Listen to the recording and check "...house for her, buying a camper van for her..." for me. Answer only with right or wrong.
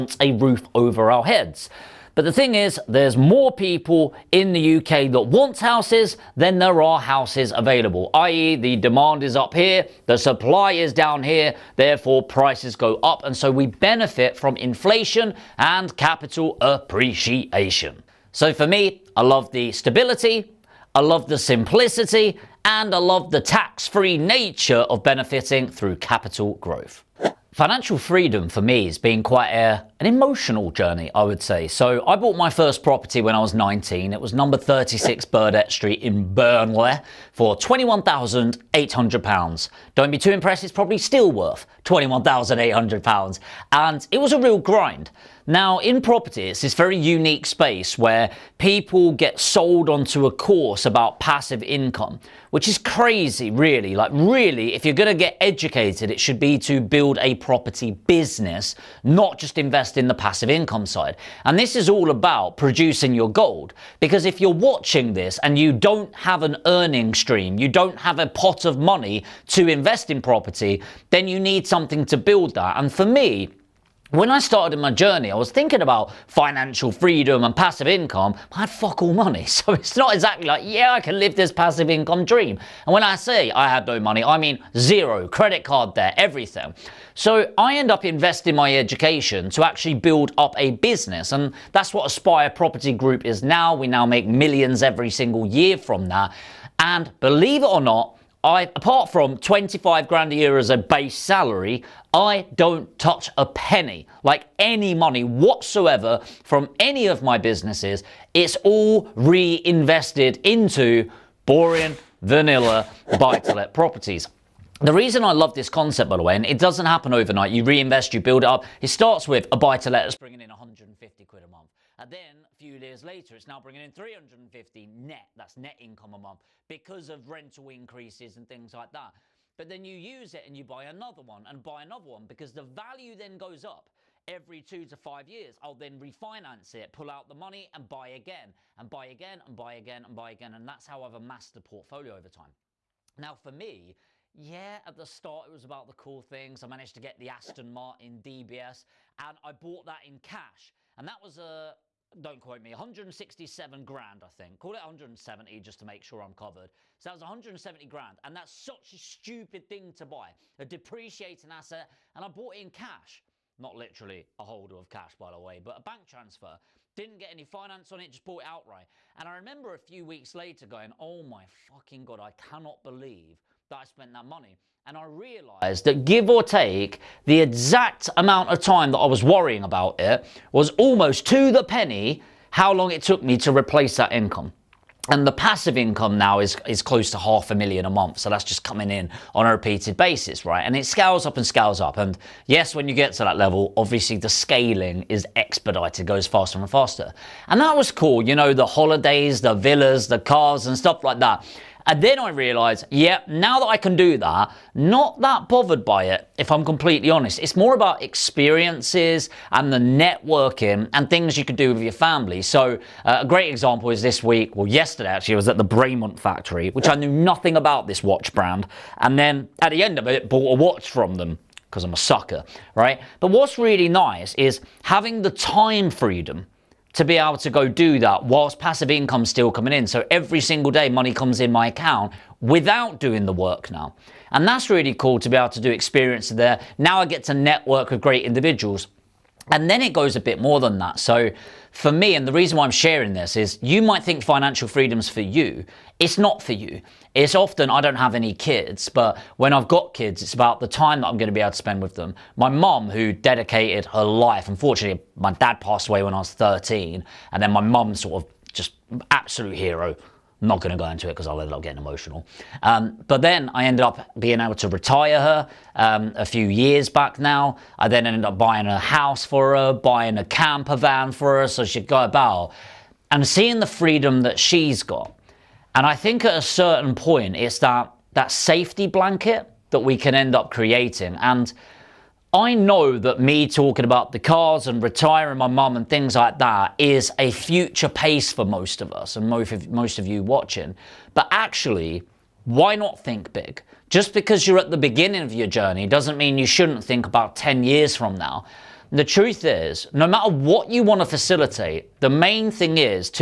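right.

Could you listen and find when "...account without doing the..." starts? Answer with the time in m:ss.
3:51.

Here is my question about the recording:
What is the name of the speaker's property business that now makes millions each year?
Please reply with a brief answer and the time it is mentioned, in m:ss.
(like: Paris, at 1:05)
Aspire Property Group, at 1:32.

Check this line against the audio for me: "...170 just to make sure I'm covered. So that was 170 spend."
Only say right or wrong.
wrong.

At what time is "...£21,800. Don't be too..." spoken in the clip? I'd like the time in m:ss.
0:37.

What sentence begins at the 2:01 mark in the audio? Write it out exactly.
And then a few years later, it's now bringing in 350 net.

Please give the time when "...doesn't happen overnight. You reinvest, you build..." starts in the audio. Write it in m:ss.
1:56.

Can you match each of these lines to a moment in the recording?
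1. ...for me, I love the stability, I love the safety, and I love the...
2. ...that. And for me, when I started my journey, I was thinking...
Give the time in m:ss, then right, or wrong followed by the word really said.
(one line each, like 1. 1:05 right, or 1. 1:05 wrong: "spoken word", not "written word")
1. 0:18 wrong: "simplicity", not "safety"
2. 1:12 right.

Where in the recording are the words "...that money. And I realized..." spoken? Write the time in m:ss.
2:54.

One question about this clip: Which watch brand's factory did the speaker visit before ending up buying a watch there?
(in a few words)
Bremont.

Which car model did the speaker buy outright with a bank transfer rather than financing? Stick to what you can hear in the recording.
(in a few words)
Aston Martin DBS.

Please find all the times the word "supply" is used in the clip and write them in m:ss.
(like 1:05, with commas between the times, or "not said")
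0:10.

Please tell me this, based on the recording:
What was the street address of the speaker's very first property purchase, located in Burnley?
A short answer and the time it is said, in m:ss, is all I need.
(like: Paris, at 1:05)
36 Burdett Street, at 0:34.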